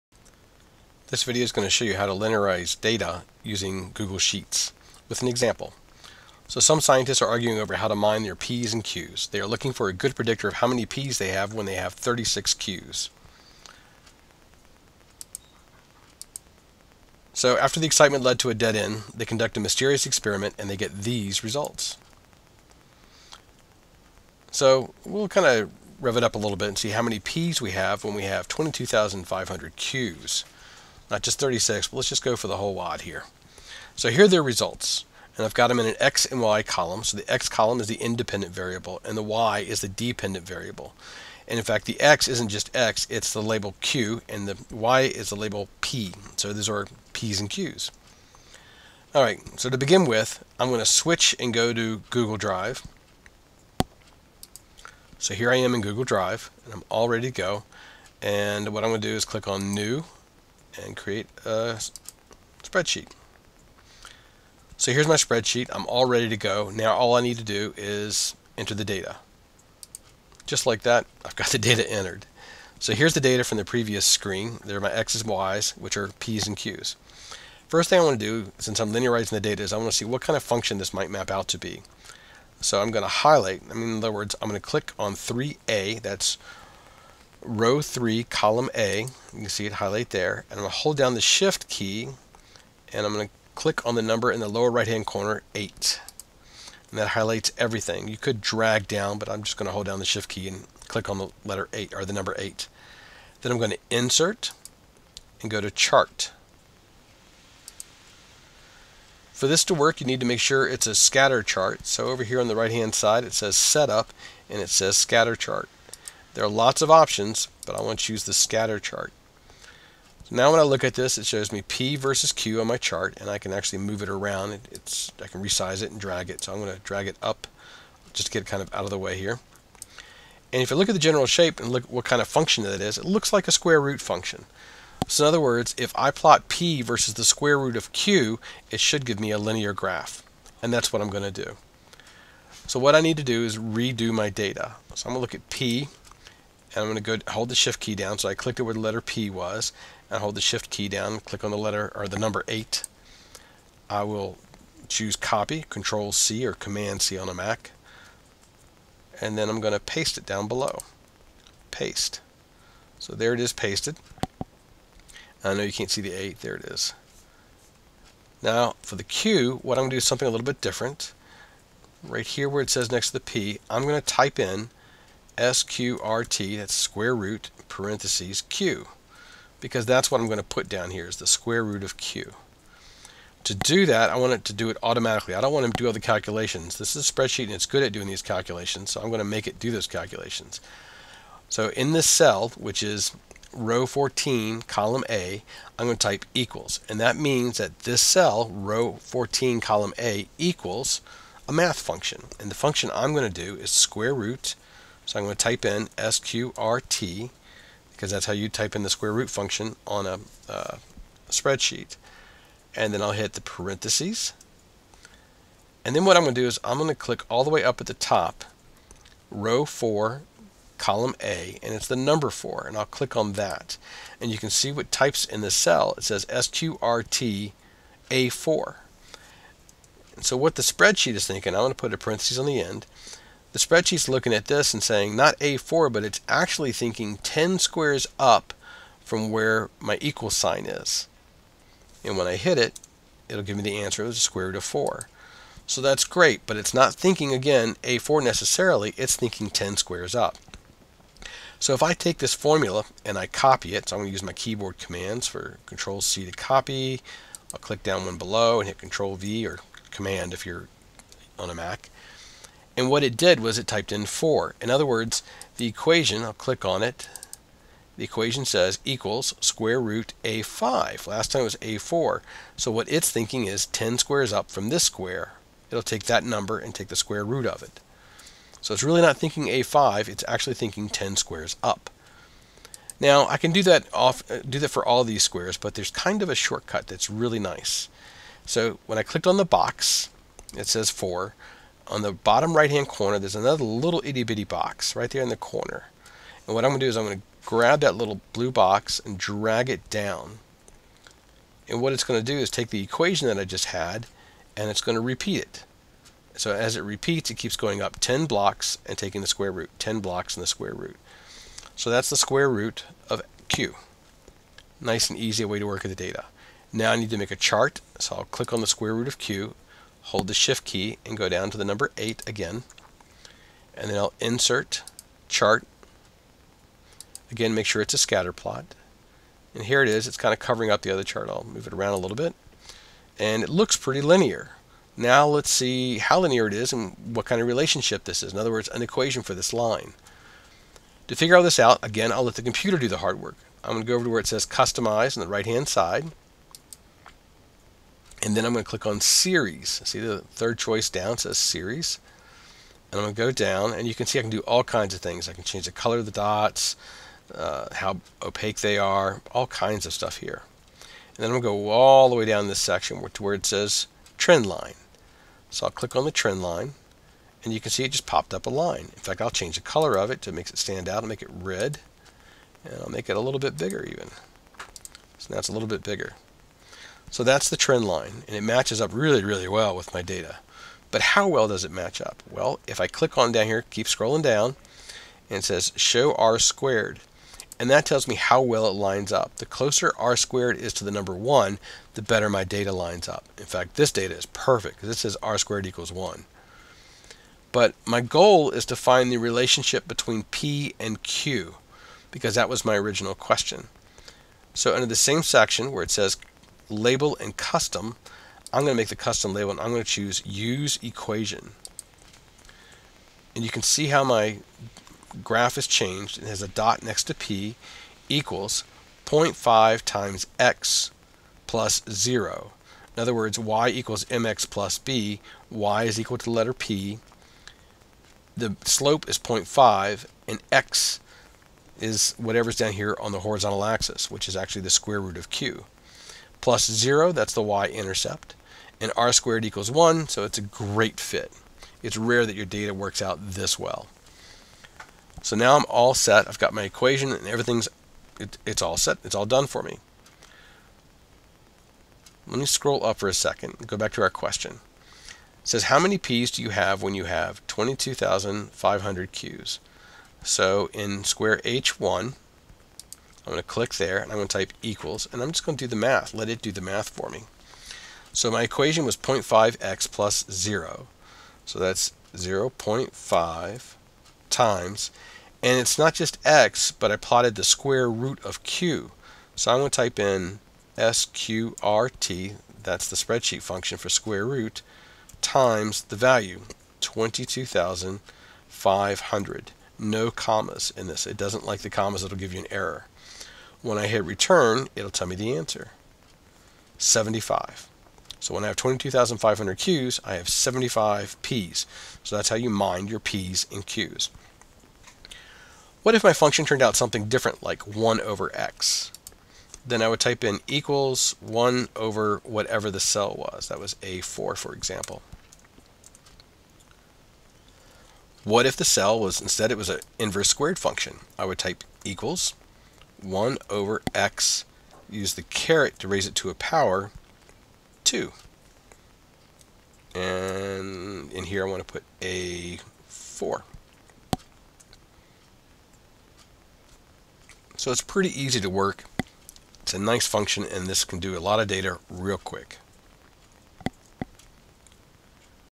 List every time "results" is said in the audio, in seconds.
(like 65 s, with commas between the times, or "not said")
21 s, 34 s.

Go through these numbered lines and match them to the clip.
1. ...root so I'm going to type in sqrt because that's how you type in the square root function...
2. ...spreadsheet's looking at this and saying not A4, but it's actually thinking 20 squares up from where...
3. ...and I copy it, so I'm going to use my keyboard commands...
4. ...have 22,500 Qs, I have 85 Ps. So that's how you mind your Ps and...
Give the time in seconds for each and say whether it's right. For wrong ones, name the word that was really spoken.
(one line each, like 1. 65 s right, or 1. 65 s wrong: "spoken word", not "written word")
1. 204 s right
2. 233 s wrong: "10", not "20"
3. 253 s right
4. 498 s wrong: "75", not "85".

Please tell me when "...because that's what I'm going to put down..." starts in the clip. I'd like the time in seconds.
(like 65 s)
179 s.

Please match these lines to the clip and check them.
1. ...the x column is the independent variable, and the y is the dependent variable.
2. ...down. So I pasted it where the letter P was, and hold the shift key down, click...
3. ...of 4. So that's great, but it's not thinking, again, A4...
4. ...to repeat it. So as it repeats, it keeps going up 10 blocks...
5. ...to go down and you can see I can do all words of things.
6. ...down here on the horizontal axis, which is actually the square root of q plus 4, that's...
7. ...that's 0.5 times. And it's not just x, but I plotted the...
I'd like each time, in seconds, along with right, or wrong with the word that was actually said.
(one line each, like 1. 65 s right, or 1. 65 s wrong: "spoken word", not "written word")
1. 37 s right
2. 147 s wrong: "clicked", not "pasted"
3. 244 s right
4. 304 s right
5. 353 s wrong: "kinds", not "words"
6. 432 s wrong: "0", not "4"
7. 471 s right.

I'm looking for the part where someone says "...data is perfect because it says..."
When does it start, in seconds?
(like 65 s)
393 s.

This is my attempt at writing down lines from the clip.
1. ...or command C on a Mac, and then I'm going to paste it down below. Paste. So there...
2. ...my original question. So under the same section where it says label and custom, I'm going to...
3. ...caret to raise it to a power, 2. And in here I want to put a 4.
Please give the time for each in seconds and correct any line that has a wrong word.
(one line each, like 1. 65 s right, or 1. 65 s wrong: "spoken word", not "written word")
1. 156 s right
2. 402 s right
3. 525 s right.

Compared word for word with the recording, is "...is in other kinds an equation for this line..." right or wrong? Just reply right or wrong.
wrong.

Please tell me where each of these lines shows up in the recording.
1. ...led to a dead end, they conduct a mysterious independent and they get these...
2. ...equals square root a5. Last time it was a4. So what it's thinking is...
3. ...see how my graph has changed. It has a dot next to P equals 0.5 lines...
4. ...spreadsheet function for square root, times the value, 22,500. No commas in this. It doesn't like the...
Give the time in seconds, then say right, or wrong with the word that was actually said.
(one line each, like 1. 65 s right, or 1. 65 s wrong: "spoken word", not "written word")
1. 18 s wrong: "experiment", not "independent"
2. 268 s right
3. 413 s wrong: "times", not "lines"
4. 482 s right.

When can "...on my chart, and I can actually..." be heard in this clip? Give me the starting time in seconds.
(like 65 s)
122 s.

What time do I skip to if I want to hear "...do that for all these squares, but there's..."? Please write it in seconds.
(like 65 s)
284 s.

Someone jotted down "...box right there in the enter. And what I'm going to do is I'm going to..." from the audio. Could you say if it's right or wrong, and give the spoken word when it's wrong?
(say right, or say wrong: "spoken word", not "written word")
wrong: "corner", not "enter".